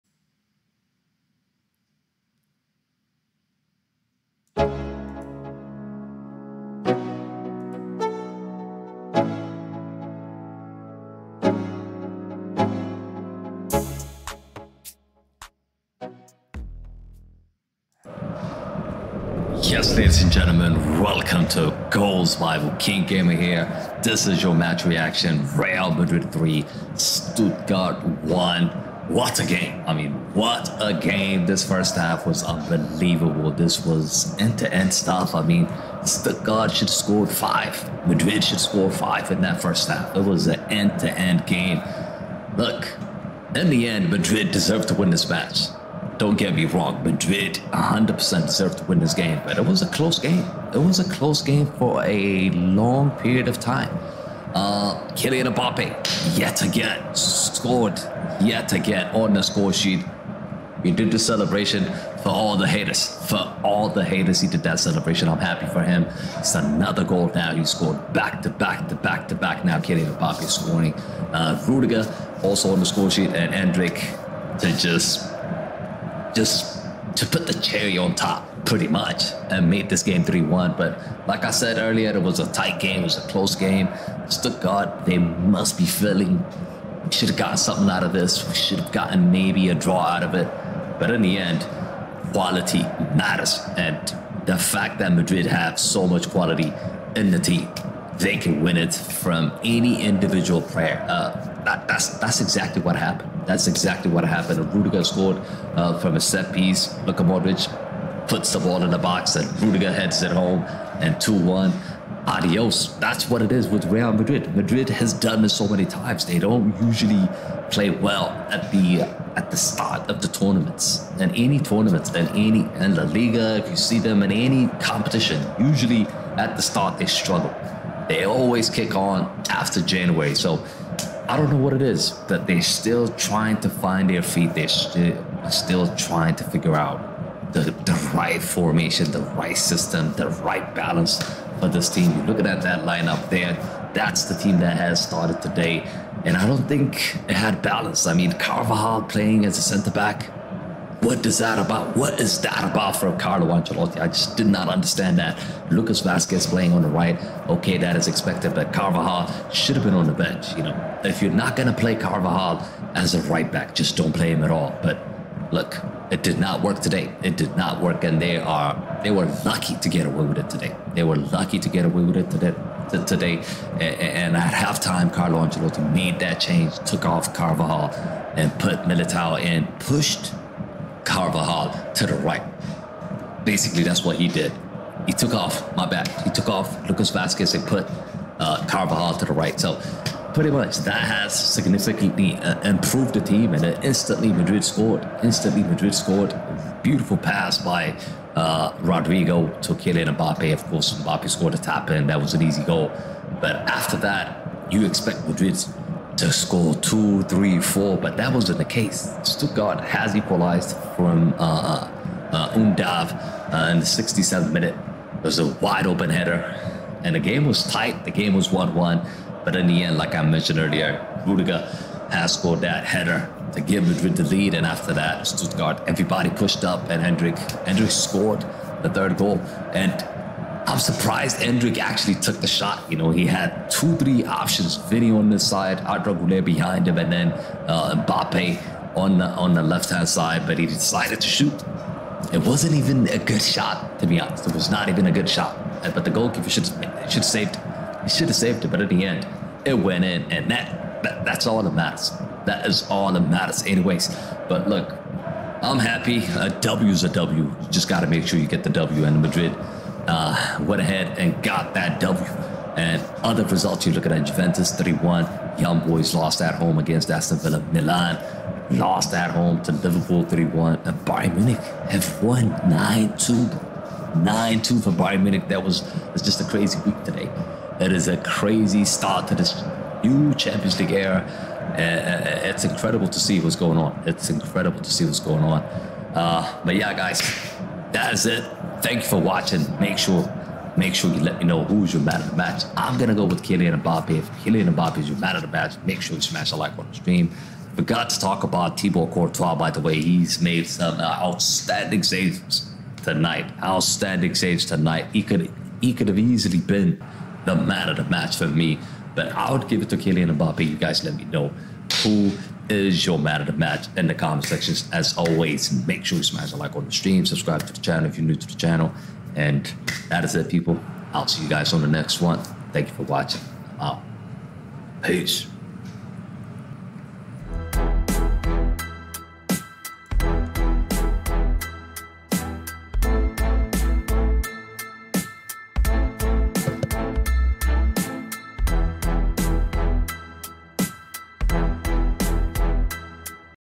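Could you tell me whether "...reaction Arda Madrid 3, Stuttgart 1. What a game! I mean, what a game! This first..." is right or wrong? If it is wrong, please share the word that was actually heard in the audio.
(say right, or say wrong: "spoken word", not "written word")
wrong: "Real", not "Arda".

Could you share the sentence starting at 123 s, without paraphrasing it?
If you see them in any competition, usually at the start they struggle.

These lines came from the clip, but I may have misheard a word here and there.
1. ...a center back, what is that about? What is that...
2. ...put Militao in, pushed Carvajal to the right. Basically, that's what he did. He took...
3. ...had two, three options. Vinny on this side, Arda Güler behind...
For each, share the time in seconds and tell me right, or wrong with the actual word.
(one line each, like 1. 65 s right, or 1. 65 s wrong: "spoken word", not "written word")
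1. 149 s right
2. 178 s right
3. 233 s right.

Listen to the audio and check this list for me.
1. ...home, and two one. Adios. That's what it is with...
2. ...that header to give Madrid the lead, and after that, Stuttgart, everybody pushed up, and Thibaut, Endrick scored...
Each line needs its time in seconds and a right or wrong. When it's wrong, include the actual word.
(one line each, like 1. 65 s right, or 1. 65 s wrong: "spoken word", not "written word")
1. 110 s right
2. 222 s wrong: "Endrick", not "Thibaut".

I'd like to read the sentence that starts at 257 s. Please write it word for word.
You just got to make sure you get the W, and Madrid uh, went ahead and got that W.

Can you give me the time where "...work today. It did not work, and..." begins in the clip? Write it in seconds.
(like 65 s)
166 s.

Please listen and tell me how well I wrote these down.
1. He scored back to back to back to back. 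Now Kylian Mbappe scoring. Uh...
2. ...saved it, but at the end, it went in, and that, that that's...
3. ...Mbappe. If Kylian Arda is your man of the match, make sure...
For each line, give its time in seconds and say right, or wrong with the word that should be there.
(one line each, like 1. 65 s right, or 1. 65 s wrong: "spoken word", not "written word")
1. 67 s right
2. 248 s right
3. 293 s wrong: "Mbappe", not "Arda".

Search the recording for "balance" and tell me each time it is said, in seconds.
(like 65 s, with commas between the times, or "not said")
140 s, 147 s.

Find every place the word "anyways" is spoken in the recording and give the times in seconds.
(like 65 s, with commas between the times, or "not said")
253 s.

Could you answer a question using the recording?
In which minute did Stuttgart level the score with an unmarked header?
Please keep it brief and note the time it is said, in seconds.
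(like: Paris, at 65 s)
67th, at 213 s.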